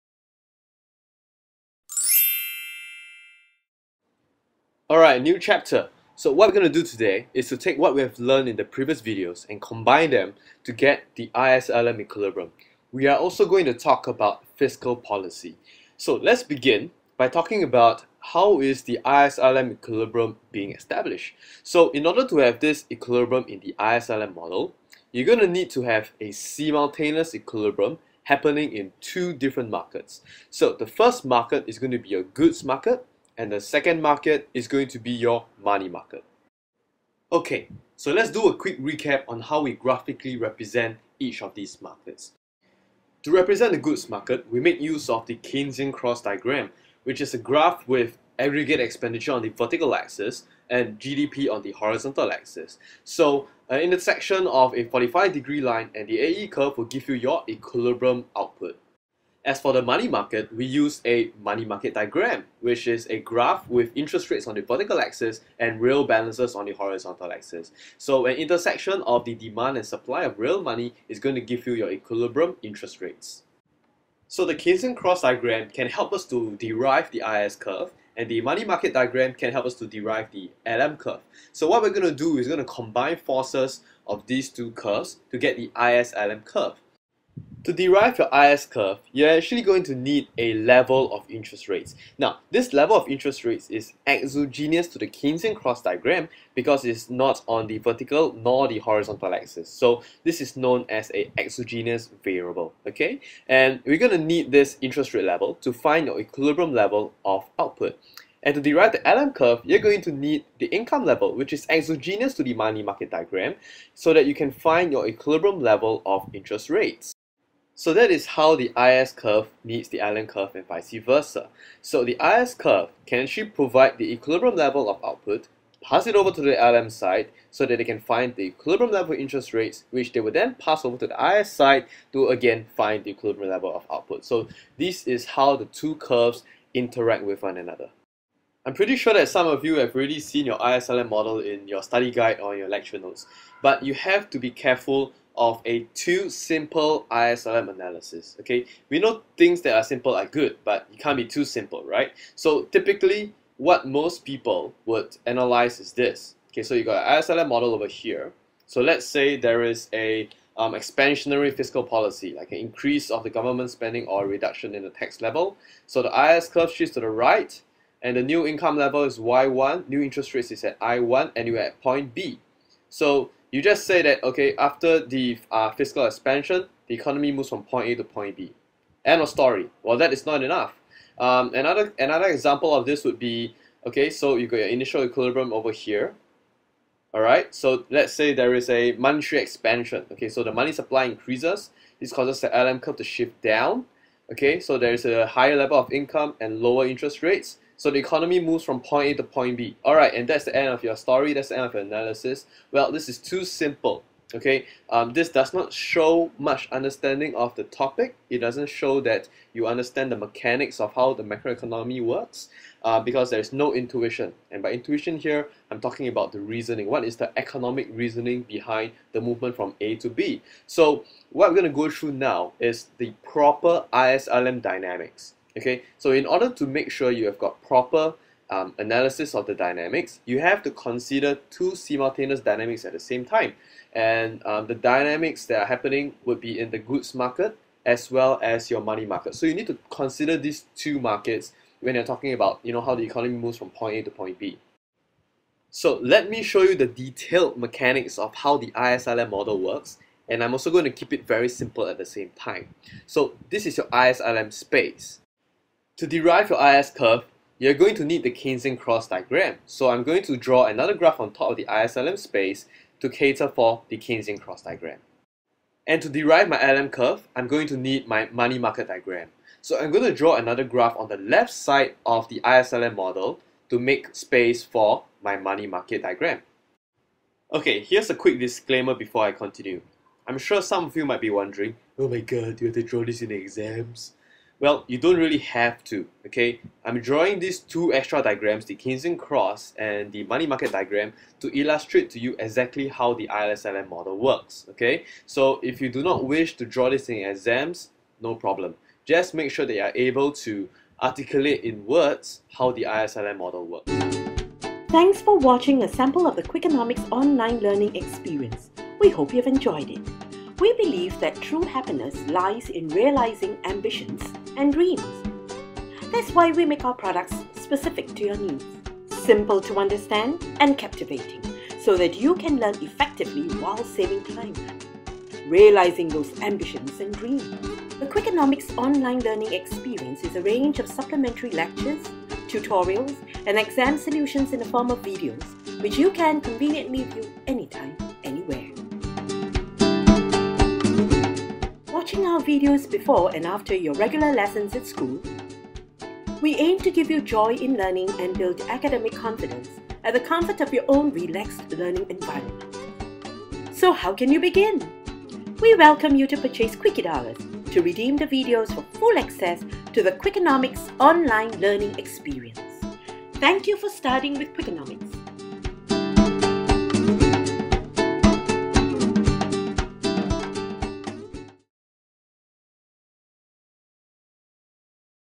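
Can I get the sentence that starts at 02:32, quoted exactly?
So typically, what most people would analyze is this.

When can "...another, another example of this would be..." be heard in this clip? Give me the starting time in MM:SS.
03:01.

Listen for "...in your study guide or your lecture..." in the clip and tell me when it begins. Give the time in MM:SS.
02:21.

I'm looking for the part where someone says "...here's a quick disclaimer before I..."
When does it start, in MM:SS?
04:37.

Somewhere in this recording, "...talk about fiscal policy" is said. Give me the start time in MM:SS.
00:13.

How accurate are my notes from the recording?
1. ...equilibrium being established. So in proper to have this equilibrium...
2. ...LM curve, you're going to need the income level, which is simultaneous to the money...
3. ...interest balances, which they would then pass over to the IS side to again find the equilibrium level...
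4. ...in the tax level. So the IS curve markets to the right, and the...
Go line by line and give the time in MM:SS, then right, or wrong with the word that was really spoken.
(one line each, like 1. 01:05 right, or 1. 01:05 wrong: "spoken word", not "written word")
1. 00:19 wrong: "order", not "proper"
2. 01:49 wrong: "exogenous", not "simultaneous"
3. 02:09 wrong: "rates", not "balances"
4. 02:44 wrong: "shifts", not "markets".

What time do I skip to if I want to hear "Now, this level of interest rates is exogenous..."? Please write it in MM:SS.
01:32.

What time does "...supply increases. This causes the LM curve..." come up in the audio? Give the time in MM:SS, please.
03:10.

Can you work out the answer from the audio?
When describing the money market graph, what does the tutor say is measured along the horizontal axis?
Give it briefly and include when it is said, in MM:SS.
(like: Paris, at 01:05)
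Real balances, at 01:05.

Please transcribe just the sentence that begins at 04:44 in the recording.
Well, you don't really have to, okay?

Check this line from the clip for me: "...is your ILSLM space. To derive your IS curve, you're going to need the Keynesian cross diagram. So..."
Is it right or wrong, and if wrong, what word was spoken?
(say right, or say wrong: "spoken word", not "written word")
wrong: "ISLM", not "ILSLM".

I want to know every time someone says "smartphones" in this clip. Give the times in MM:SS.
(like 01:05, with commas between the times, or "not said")
not said.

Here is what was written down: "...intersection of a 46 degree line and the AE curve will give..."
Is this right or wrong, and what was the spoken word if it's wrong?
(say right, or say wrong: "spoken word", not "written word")
wrong: "45", not "46".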